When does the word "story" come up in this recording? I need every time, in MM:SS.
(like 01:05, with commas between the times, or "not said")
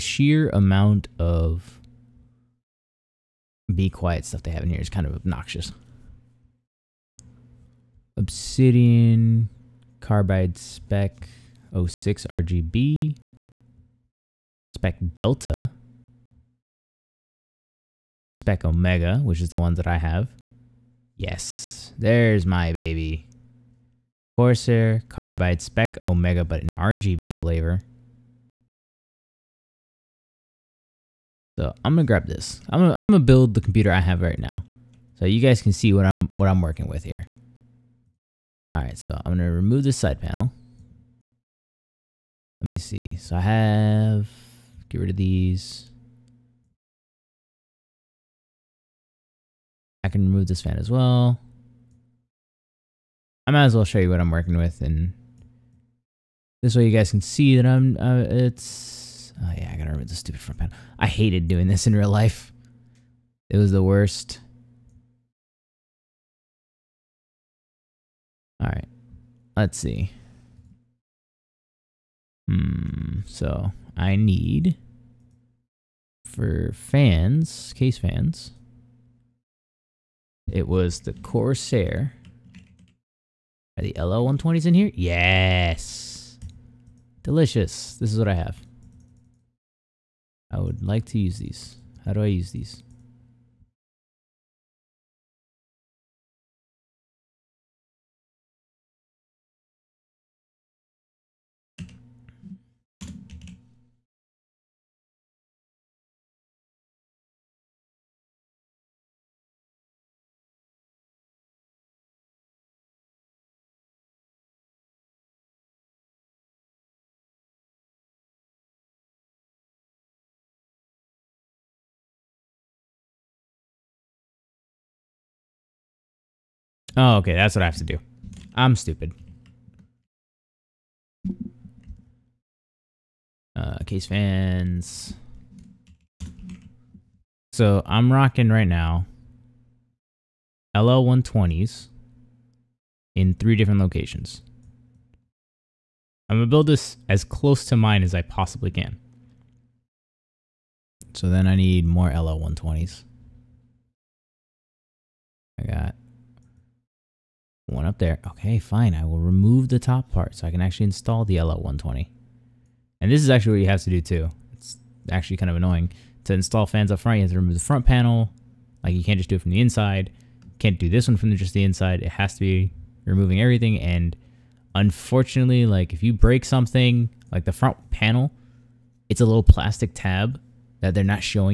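not said.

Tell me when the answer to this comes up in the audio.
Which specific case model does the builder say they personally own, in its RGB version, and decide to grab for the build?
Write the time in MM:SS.
00:25.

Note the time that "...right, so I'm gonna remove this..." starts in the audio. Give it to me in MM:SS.
00:38.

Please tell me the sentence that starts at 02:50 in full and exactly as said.
Can't do this one from just the inside.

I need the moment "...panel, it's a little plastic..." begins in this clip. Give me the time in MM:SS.
02:57.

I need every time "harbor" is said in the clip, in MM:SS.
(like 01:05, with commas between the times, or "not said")
not said.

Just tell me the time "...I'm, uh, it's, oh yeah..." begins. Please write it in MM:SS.
00:57.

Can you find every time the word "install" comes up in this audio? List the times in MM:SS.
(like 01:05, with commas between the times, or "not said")
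02:40, 02:46.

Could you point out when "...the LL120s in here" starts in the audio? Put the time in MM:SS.
01:23.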